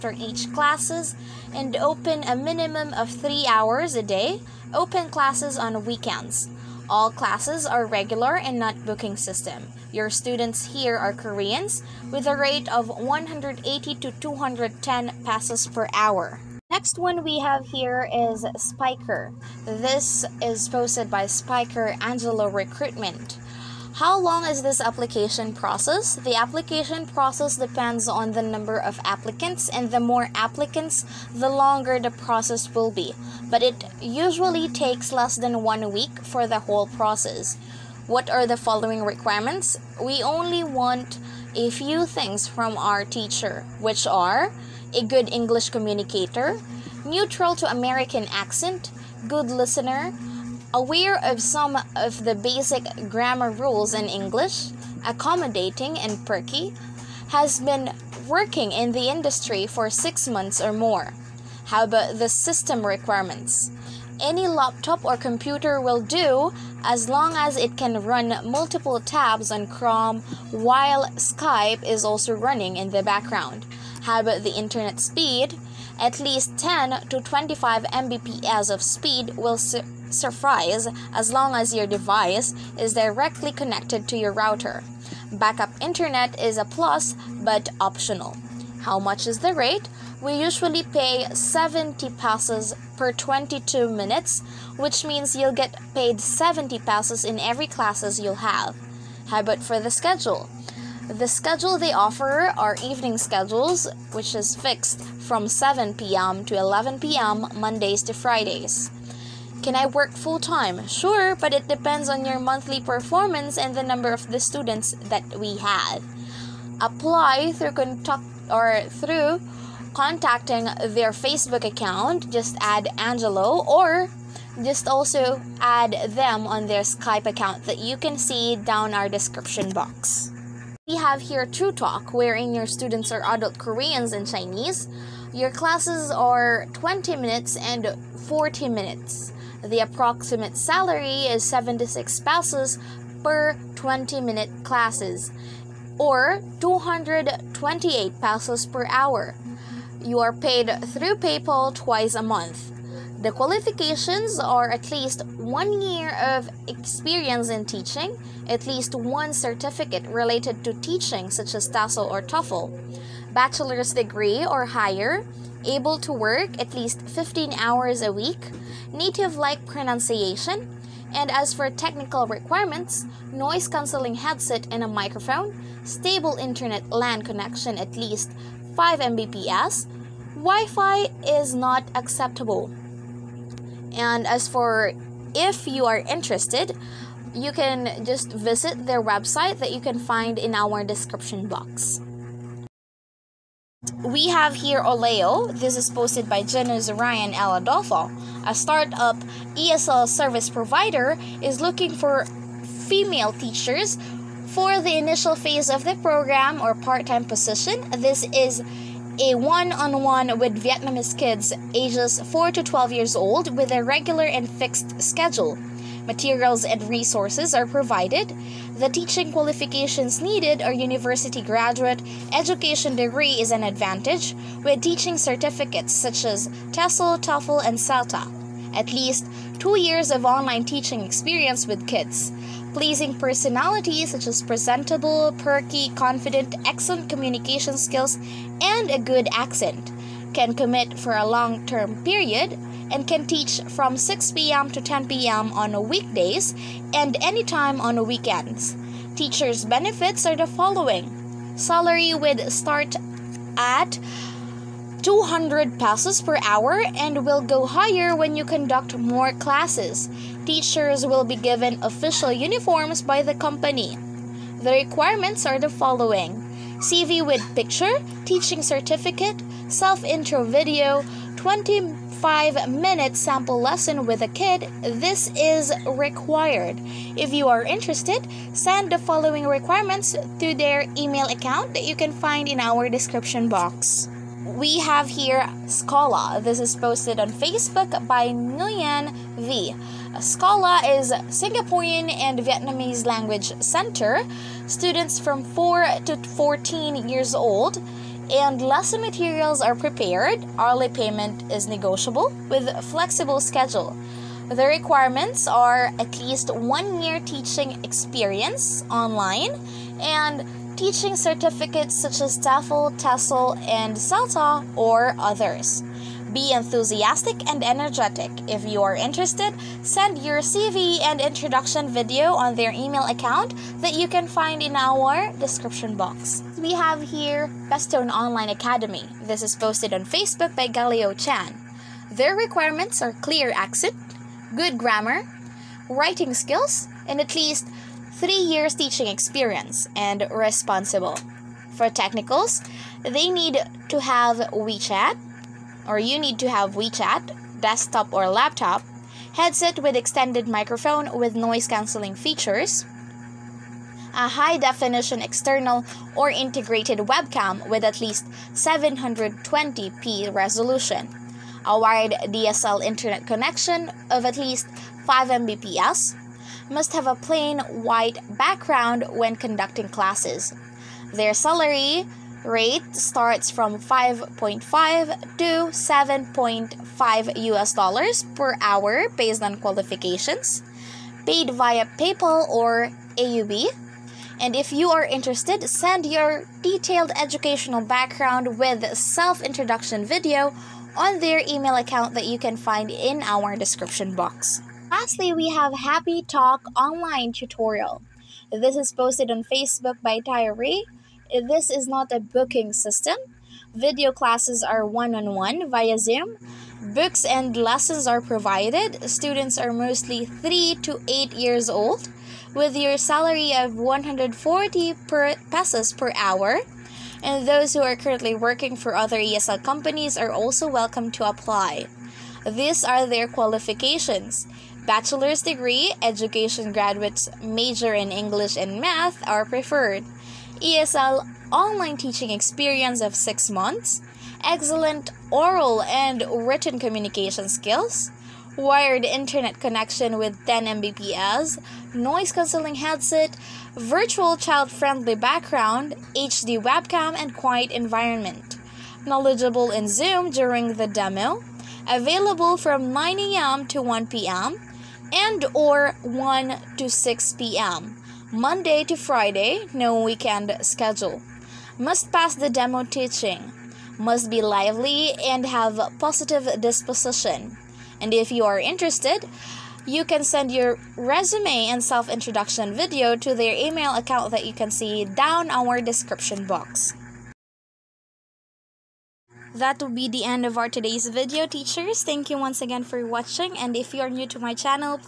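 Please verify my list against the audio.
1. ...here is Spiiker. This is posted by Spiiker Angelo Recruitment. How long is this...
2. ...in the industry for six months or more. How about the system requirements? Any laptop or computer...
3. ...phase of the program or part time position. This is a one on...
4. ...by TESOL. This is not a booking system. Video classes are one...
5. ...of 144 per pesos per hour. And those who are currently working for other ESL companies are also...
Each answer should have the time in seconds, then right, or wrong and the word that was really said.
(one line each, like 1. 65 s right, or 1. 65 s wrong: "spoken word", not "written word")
1. 17 s right
2. 58 s right
3. 205 s right
4. 400 s wrong: "Tyree", not "TESOL"
5. 413 s wrong: "140", not "144".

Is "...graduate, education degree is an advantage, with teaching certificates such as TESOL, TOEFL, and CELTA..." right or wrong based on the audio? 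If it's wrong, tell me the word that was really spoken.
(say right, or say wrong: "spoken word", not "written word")
right.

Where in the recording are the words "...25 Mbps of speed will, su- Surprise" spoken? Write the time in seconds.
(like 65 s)
77 s.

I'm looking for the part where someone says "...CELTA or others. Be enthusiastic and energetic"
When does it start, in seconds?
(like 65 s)
313 s.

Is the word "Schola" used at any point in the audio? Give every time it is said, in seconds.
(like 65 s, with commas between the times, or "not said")
285 s, 290 s.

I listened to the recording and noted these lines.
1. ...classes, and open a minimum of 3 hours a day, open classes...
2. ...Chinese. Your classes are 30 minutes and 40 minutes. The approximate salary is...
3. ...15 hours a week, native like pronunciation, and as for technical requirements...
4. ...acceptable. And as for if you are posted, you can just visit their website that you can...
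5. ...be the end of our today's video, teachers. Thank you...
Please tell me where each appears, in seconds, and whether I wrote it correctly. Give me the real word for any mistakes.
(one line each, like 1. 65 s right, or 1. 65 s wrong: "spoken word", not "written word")
1. 0 s right
2. 134 s wrong: "20", not "30"
3. 167 s right
4. 181 s wrong: "interested", not "posted"
5. 479 s right.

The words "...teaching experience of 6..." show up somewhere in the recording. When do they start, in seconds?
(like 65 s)
431 s.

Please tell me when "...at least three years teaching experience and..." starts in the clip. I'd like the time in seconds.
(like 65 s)
337 s.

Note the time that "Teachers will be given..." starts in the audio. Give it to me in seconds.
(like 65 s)
260 s.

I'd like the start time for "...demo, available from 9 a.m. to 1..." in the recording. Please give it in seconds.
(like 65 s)
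450 s.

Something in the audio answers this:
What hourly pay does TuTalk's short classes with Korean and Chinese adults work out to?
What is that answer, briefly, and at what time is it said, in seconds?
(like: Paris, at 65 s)
228 pesos, at 146 s.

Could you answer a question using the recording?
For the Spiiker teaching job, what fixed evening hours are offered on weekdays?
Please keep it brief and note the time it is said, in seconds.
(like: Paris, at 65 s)
7 p.m. to 11 p.m., at 105 s.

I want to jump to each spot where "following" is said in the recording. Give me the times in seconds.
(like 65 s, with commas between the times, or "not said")
38 s, 250 s, 265 s, 278 s.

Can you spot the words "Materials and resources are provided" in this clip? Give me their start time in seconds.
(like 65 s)
216 s.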